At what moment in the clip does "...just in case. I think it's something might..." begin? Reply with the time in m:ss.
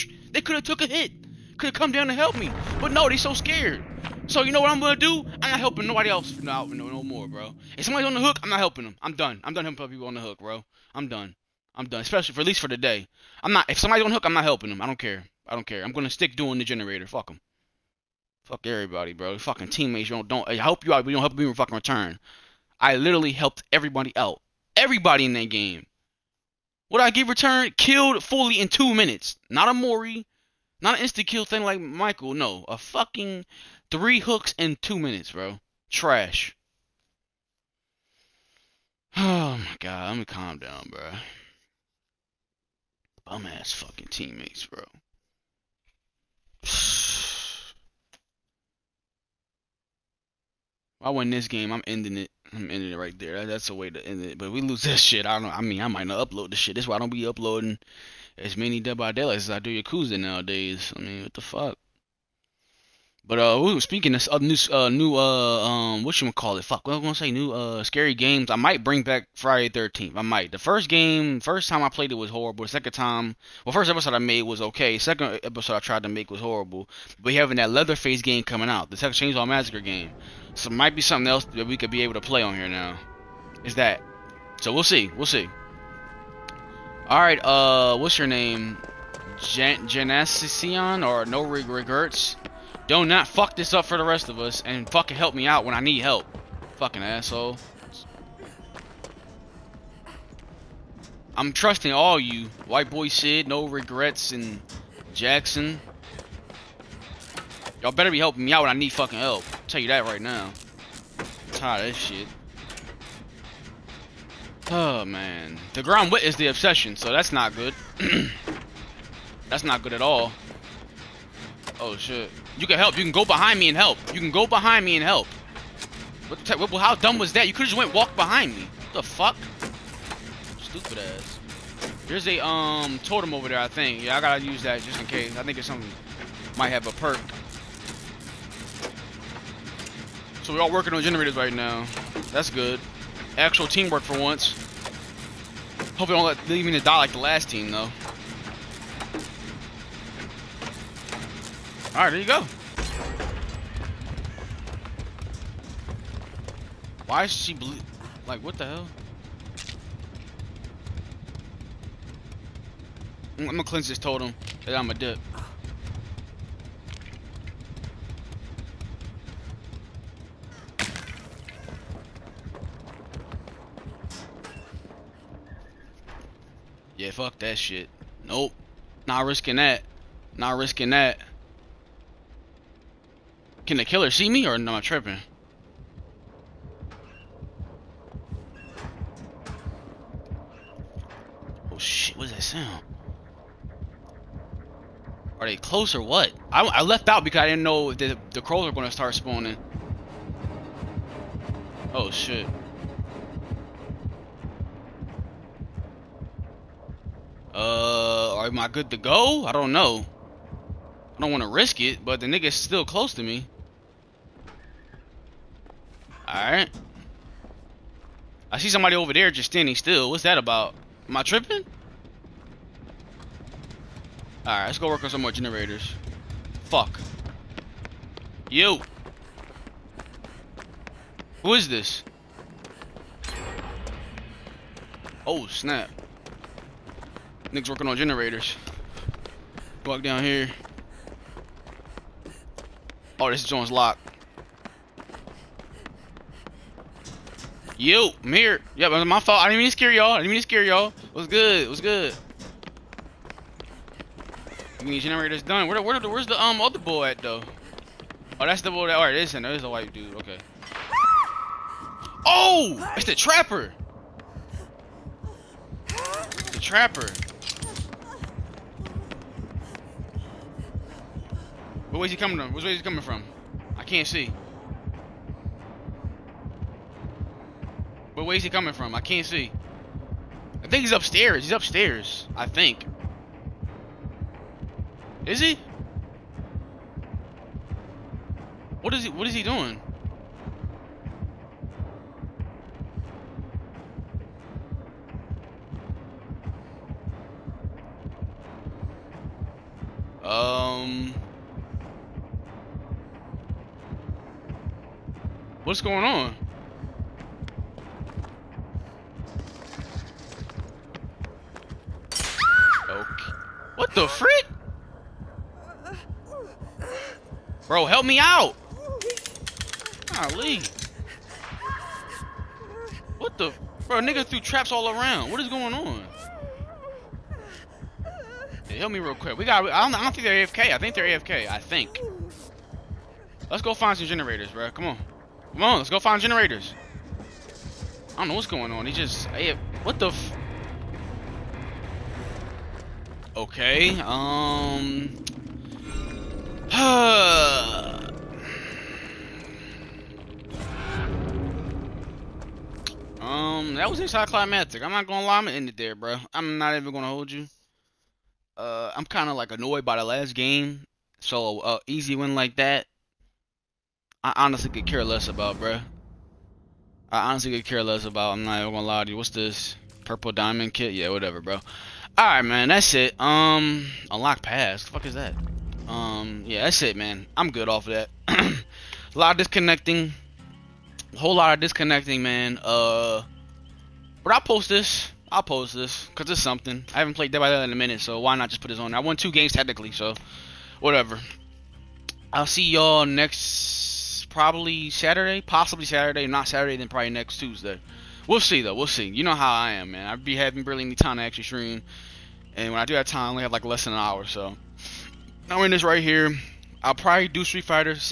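2:14.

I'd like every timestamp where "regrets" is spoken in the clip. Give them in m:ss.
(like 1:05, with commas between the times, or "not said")
1:31, 1:43.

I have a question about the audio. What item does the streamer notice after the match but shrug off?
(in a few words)
Purple diamond kit.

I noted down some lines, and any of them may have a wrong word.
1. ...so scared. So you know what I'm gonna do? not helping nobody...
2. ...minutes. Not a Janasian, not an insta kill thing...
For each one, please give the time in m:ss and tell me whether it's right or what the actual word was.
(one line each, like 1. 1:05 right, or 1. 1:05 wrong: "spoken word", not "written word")
1. 0:03 right
2. 0:28 wrong: "Mori", not "Janasian".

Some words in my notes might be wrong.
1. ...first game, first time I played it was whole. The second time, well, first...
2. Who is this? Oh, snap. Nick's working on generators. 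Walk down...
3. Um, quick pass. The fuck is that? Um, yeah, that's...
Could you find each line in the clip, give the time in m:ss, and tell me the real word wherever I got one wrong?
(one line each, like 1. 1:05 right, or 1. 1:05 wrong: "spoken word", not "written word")
1. 1:10 wrong: "horrible", not "whole"
2. 3:51 right
3. 6:13 wrong: "unlock", not "quick".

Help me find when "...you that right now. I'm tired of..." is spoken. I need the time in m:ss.
1:49.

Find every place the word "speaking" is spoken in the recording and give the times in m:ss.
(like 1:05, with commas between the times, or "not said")
1:03.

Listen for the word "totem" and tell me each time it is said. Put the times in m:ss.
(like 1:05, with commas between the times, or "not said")
2:13, 2:43.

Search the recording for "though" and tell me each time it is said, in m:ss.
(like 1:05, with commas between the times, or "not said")
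2:27, 4:17, 6:38.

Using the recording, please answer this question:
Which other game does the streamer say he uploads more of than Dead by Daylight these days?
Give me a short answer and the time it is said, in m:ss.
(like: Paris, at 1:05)
Yakuza, at 0:59.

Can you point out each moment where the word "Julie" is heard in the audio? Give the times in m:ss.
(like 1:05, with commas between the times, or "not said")
not said.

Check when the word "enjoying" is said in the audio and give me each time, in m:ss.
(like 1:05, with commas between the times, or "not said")
not said.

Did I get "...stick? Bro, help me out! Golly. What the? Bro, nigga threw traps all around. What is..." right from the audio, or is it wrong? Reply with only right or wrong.
wrong.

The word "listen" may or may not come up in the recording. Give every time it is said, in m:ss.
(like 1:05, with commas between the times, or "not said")
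4:19.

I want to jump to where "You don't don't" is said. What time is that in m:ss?
0:20.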